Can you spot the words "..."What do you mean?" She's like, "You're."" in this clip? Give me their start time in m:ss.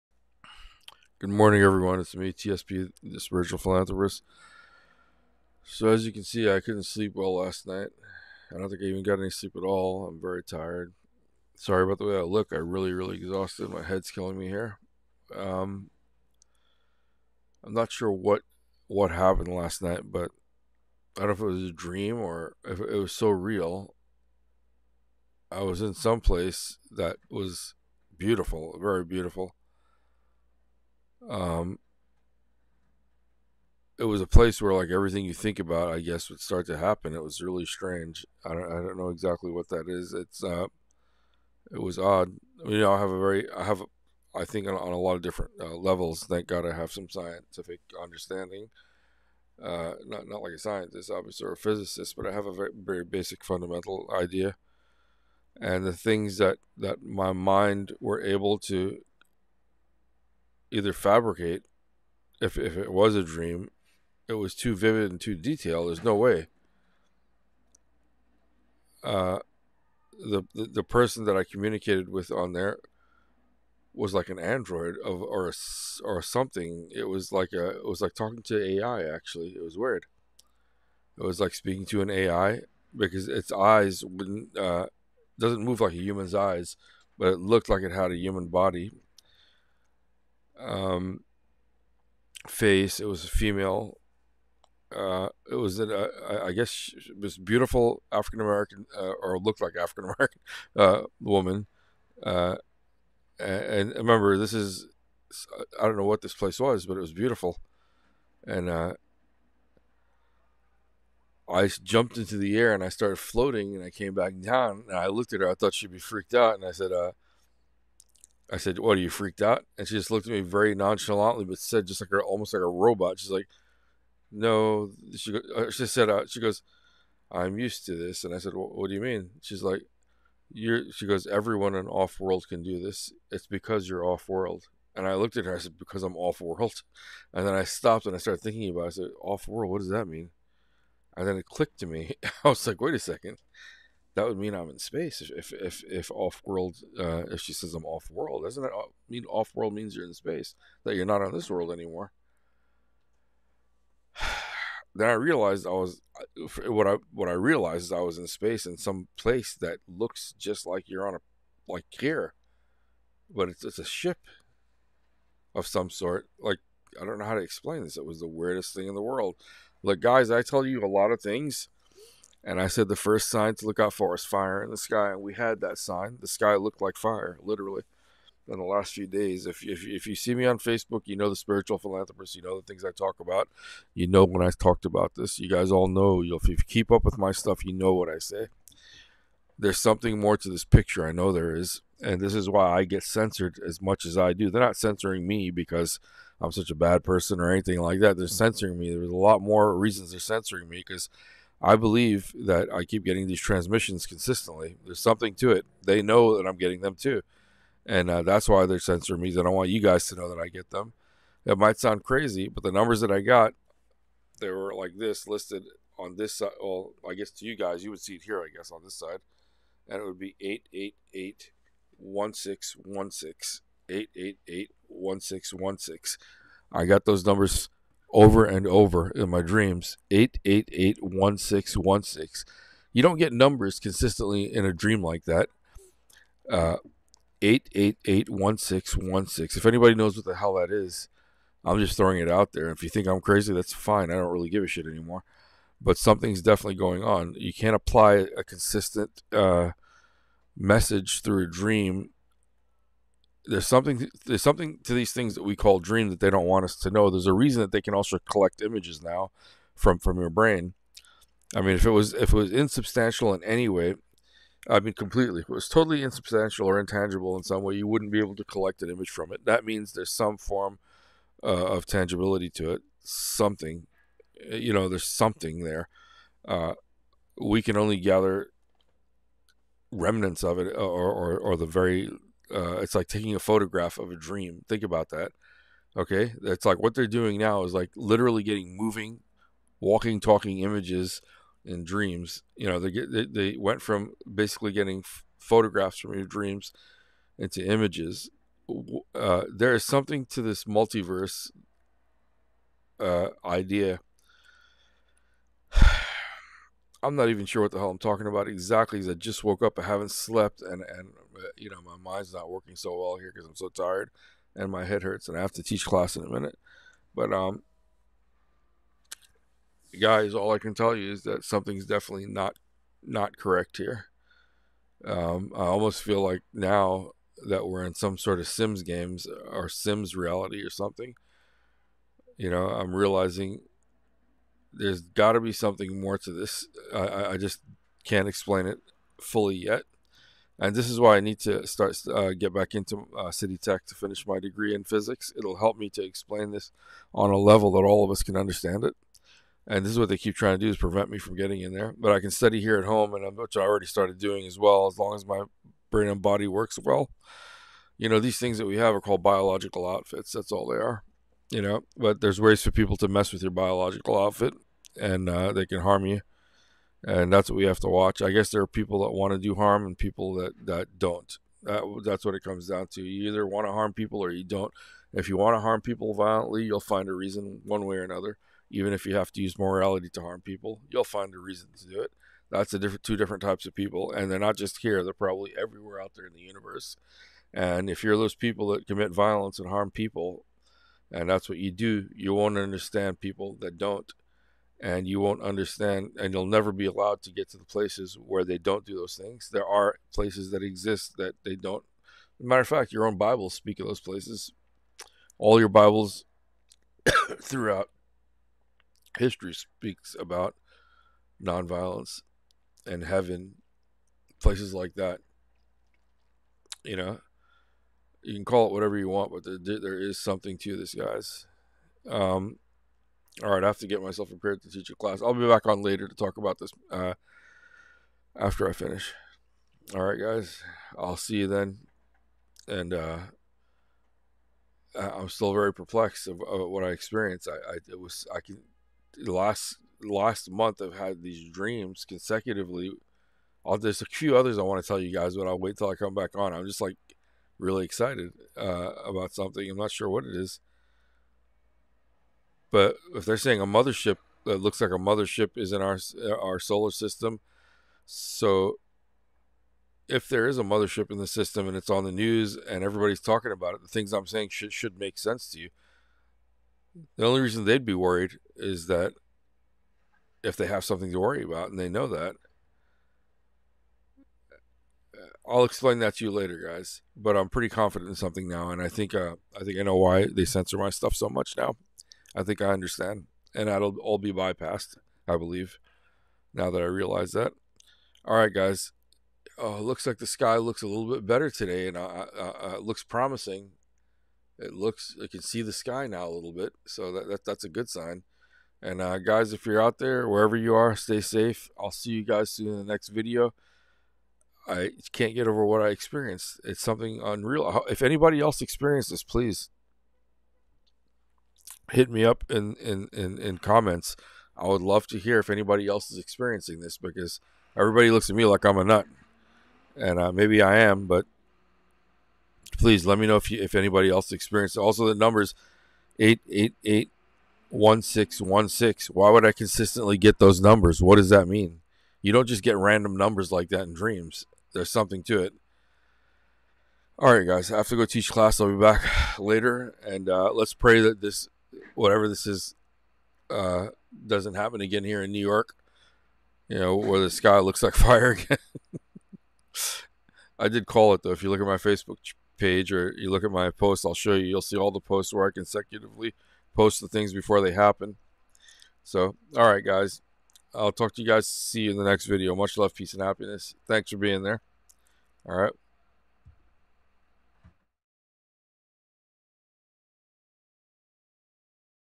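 2:08.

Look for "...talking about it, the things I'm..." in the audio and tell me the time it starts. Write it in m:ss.
7:43.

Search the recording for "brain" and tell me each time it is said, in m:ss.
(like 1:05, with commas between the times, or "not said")
4:20, 5:55.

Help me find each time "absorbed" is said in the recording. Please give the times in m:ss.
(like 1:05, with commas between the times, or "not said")
not said.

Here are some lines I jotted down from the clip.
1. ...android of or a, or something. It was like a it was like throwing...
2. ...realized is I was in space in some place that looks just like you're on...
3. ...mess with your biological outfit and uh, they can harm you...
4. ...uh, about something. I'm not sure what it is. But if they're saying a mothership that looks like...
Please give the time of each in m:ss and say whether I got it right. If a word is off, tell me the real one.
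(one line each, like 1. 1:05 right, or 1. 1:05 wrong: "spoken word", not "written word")
1. 1:14 wrong: "talking", not "throwing"
2. 2:37 right
3. 6:03 right
4. 7:28 right.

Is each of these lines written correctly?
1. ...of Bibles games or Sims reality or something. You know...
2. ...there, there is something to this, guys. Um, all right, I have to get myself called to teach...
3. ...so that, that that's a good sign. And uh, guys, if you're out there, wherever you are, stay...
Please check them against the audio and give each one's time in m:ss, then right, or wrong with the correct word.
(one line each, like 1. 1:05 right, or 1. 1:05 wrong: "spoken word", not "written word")
1. 5:28 wrong: "Sims", not "Bibles"
2. 6:59 wrong: "prepared", not "called"
3. 8:16 right.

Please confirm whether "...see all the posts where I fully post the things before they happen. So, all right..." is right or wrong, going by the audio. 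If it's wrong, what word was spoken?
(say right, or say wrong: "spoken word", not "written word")
wrong: "consecutively", not "fully".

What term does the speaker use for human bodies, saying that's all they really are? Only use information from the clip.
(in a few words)
biological outfits.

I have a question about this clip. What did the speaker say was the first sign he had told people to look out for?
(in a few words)
fire in the sky.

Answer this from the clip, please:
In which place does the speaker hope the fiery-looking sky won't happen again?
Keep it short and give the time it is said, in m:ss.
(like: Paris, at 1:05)
New York, at 9:05.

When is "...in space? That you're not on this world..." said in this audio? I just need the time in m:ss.
2:30.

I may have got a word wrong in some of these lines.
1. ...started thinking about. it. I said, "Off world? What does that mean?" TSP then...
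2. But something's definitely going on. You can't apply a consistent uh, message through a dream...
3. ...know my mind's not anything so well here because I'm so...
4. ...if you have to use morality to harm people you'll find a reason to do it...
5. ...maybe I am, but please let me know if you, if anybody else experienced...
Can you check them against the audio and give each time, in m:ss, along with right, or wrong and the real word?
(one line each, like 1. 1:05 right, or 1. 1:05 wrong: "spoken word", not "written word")
1. 2:18 wrong: "And", not "TSP"
2. 4:05 right
3. 5:11 wrong: "working", not "anything"
4. 6:18 right
5. 8:40 right.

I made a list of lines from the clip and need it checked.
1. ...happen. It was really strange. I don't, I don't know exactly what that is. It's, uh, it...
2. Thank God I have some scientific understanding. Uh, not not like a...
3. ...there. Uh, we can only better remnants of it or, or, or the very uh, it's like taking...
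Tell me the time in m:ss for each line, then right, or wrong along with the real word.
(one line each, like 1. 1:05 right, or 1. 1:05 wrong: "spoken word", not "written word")
1. 0:36 right
2. 0:46 right
3. 4:35 wrong: "gather", not "better".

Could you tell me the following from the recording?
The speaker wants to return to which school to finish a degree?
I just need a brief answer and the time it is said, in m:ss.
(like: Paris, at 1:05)
City Tech, at 5:43.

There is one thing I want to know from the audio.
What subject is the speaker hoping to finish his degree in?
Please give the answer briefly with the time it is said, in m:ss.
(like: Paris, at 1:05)
physics, at 5:44.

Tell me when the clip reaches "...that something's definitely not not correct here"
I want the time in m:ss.
5:21.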